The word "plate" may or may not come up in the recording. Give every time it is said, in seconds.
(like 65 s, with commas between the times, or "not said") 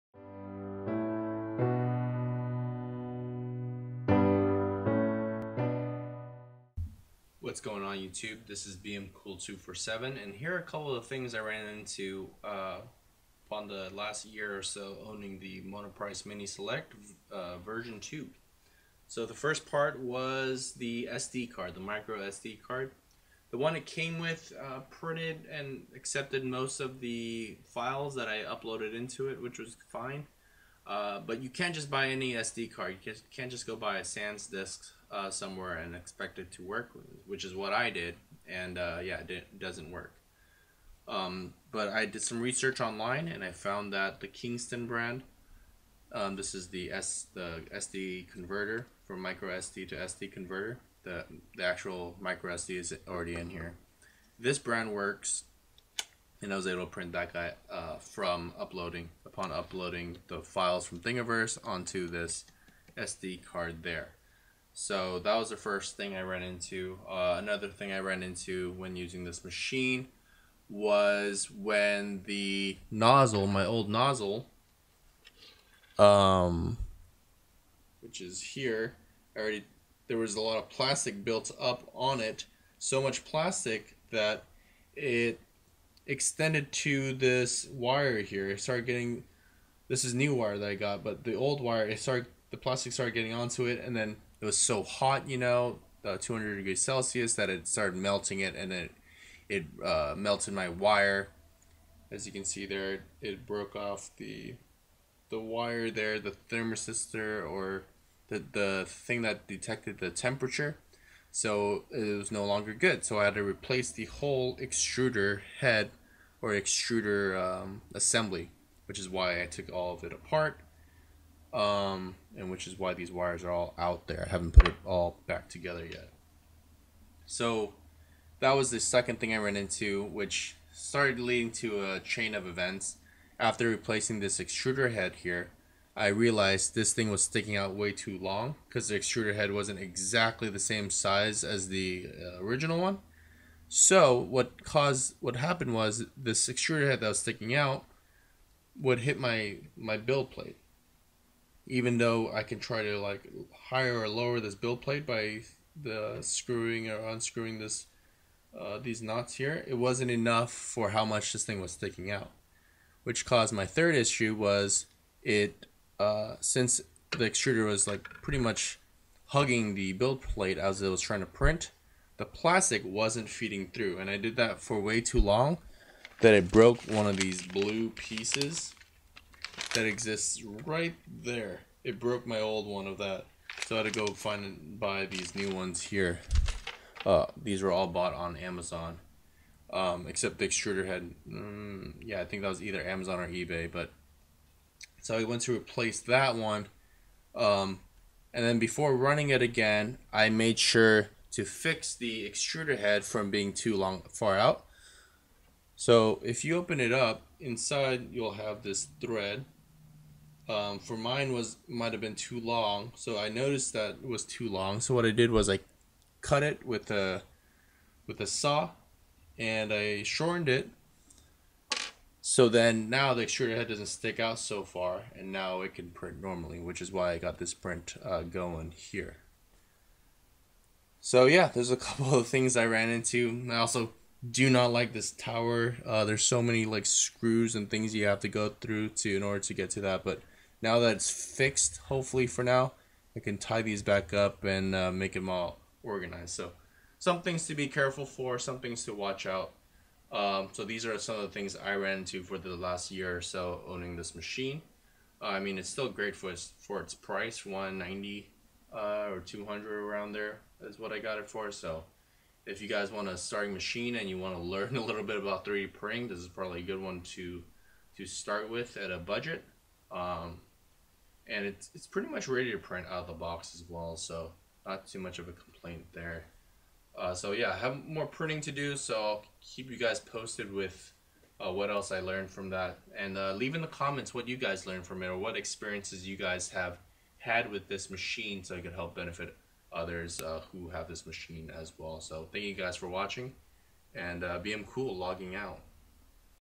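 150 s, 154 s, 170 s.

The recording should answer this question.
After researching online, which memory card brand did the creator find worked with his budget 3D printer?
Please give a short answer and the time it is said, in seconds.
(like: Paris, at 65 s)
Kingston, at 44 s.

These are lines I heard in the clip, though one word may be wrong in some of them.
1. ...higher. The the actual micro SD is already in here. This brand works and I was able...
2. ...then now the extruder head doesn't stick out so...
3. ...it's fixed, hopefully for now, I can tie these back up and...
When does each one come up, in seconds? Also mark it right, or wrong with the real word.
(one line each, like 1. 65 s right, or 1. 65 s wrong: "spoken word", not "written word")
1. 50 s wrong: "converter", not "higher"
2. 222 s right
3. 240 s right.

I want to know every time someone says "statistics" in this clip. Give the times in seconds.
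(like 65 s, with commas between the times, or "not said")
not said.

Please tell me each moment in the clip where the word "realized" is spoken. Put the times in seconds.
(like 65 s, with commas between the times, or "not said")
136 s.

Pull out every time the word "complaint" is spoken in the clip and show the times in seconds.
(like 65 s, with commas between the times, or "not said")
275 s.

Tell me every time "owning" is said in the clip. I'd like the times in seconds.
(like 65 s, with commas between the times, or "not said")
15 s, 253 s.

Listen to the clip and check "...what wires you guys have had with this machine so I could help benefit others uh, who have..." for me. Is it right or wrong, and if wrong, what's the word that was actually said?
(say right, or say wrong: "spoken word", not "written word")
wrong: "experiences", not "wires".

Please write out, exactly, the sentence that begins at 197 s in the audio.
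Um, and then before running it again, I made sure to fix the extruder head from being too long far out.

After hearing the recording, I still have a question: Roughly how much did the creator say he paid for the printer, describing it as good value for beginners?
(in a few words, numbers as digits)
190.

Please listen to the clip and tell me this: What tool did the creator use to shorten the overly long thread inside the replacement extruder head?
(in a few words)
a saw.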